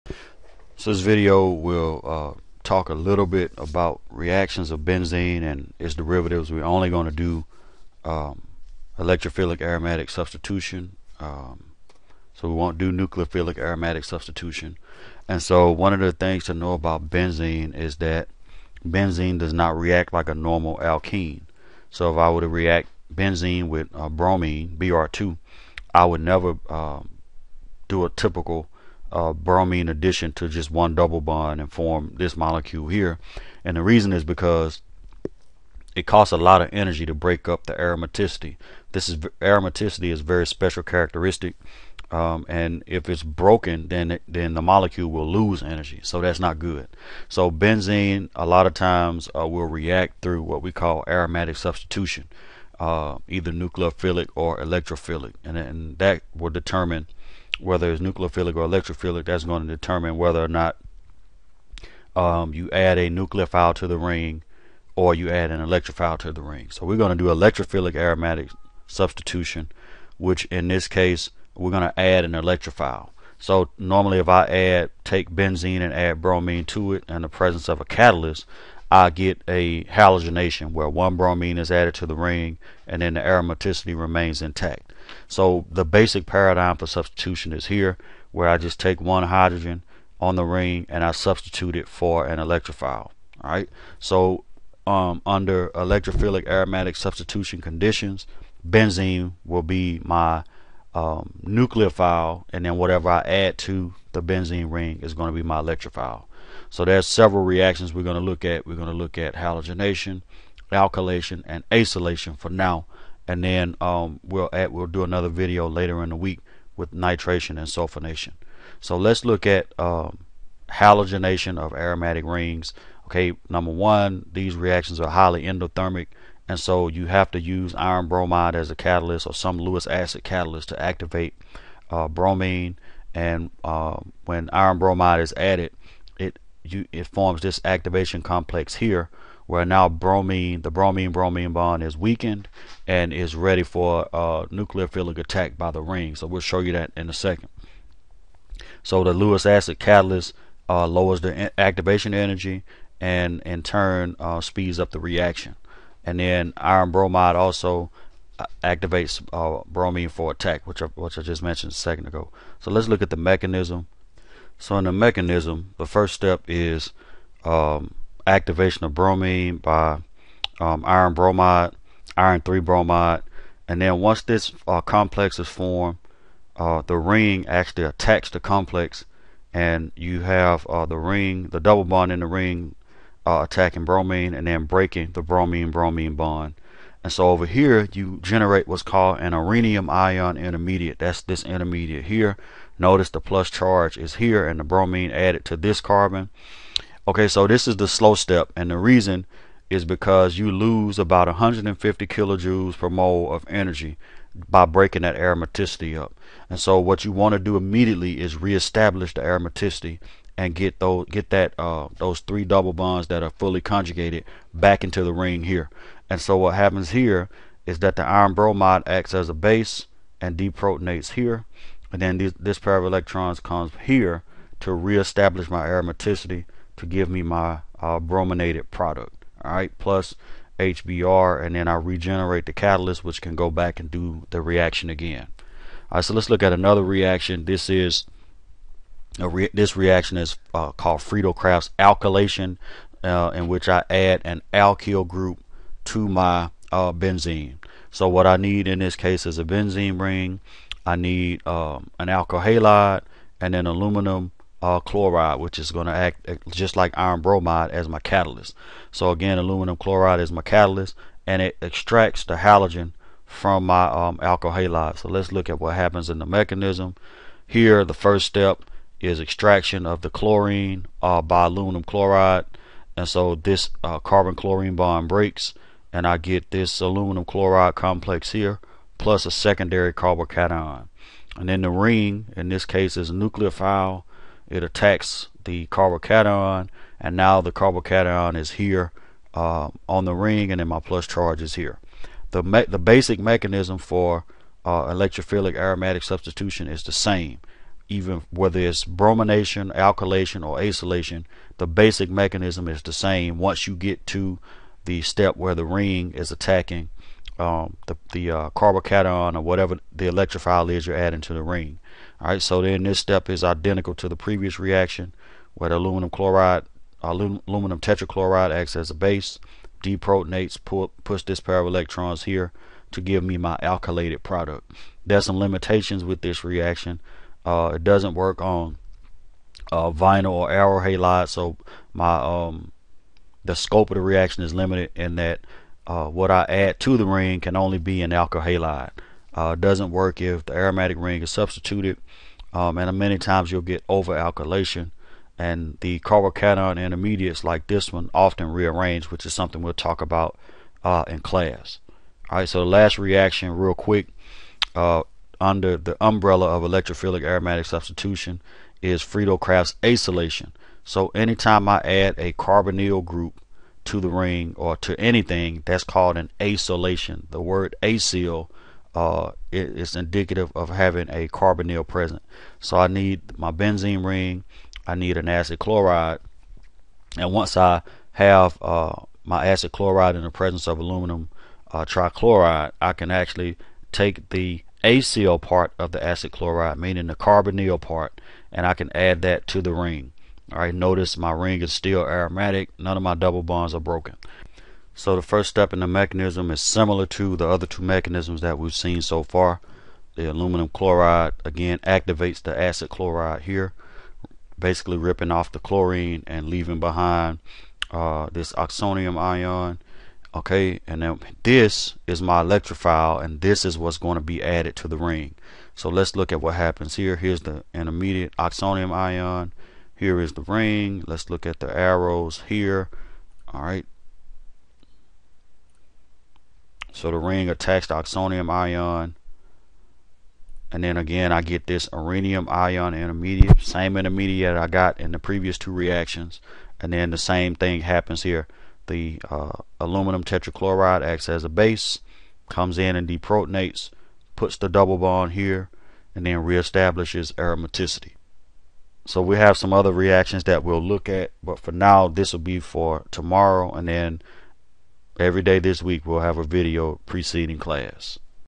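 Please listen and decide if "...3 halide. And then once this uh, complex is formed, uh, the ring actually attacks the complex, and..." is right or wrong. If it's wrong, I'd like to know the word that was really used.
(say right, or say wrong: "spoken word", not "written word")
wrong: "bromide", not "halide".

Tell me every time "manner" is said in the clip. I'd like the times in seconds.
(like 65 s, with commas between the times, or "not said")
not said.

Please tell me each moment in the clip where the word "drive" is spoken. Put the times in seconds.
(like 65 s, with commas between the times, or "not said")
not said.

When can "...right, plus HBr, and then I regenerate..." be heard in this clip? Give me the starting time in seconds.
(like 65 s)
229 s.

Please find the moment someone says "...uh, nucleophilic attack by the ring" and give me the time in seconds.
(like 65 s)
144 s.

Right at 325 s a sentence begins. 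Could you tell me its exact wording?
There's some limitations with this reaction.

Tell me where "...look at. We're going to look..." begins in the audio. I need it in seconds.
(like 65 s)
108 s.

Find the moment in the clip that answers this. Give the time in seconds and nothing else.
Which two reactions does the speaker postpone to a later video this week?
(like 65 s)
116 s.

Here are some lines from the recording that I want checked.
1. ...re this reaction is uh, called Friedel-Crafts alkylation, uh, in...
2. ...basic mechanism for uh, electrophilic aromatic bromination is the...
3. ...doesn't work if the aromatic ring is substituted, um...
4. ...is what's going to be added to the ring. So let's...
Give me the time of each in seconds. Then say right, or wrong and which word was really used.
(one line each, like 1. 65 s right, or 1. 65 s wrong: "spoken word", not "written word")
1. 239 s right
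2. 292 s wrong: "substitution", not "bromination"
3. 339 s right
4. 413 s right.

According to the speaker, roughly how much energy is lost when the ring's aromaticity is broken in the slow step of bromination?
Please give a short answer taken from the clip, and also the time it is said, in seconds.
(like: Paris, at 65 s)
150 kilojoules per mole, at 201 s.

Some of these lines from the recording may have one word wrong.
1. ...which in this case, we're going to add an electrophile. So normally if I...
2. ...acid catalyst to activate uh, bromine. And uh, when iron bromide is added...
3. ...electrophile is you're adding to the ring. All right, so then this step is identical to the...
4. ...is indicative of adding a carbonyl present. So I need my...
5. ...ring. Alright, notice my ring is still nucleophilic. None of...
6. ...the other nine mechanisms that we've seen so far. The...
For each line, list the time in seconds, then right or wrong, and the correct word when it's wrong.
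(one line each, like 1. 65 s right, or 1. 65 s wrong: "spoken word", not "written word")
1. 70 s right
2. 129 s right
3. 310 s right
4. 369 s wrong: "having", not "adding"
5. 389 s wrong: "aromatic", not "nucleophilic"
6. 397 s wrong: "two", not "nine".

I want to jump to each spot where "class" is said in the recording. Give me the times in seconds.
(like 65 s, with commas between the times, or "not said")
351 s, 457 s.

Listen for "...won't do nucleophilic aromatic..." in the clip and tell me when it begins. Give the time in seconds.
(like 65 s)
12 s.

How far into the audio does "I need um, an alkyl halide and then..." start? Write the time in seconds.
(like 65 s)
250 s.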